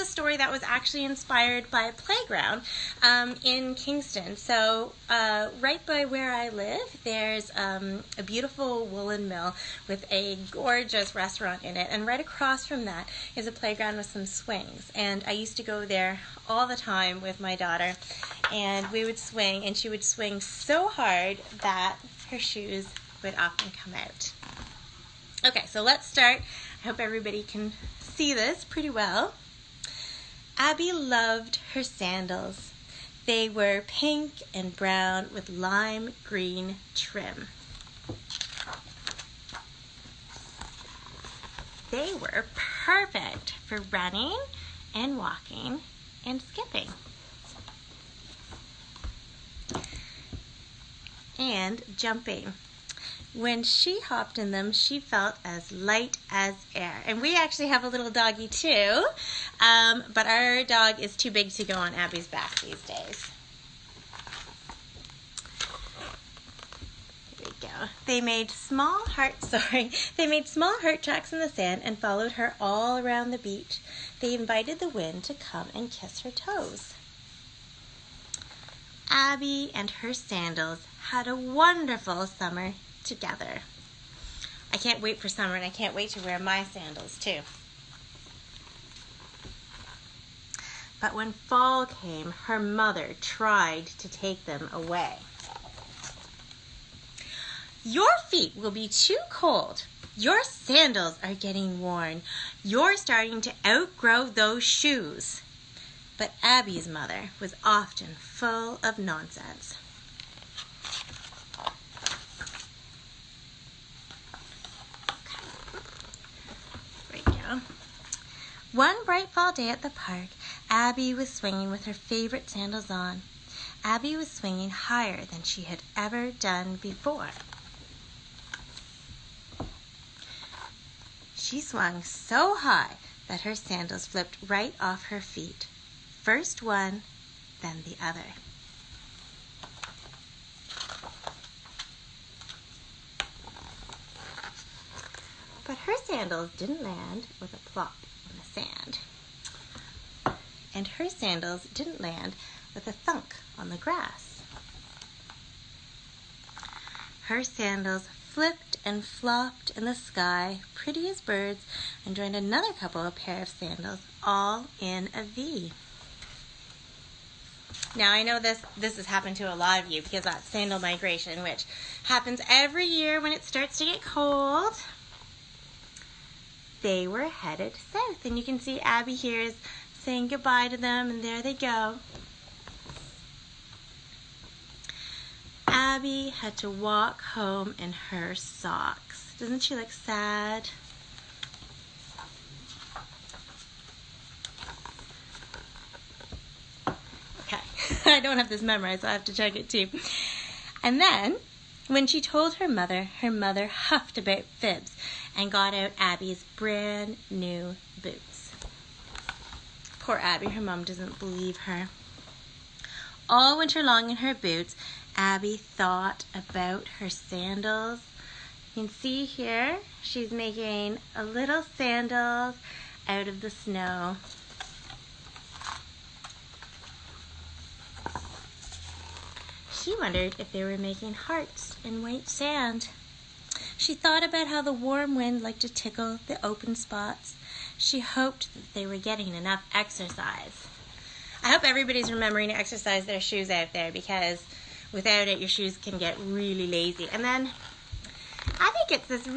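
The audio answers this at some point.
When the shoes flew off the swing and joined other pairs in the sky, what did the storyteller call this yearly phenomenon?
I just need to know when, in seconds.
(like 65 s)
170 s.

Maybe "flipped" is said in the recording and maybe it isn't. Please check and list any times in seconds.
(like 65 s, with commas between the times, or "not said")
134 s, 158 s.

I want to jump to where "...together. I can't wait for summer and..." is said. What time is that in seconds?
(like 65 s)
83 s.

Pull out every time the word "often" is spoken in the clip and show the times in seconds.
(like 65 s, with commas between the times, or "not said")
23 s, 107 s.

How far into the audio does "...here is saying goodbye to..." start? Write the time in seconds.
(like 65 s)
179 s.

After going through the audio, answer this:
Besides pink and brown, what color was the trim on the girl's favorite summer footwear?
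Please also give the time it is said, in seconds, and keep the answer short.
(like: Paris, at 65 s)
Lime green, at 35 s.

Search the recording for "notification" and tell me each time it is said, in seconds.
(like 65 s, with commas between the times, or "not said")
not said.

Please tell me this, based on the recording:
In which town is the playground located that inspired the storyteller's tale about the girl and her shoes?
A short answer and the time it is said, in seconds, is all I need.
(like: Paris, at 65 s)
Kingston, at 3 s.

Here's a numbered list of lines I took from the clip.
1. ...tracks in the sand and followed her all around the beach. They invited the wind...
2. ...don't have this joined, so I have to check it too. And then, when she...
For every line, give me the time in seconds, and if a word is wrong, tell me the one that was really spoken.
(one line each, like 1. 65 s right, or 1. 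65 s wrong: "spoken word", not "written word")
1. 71 s right
2. 198 s wrong: "memorized", not "joined".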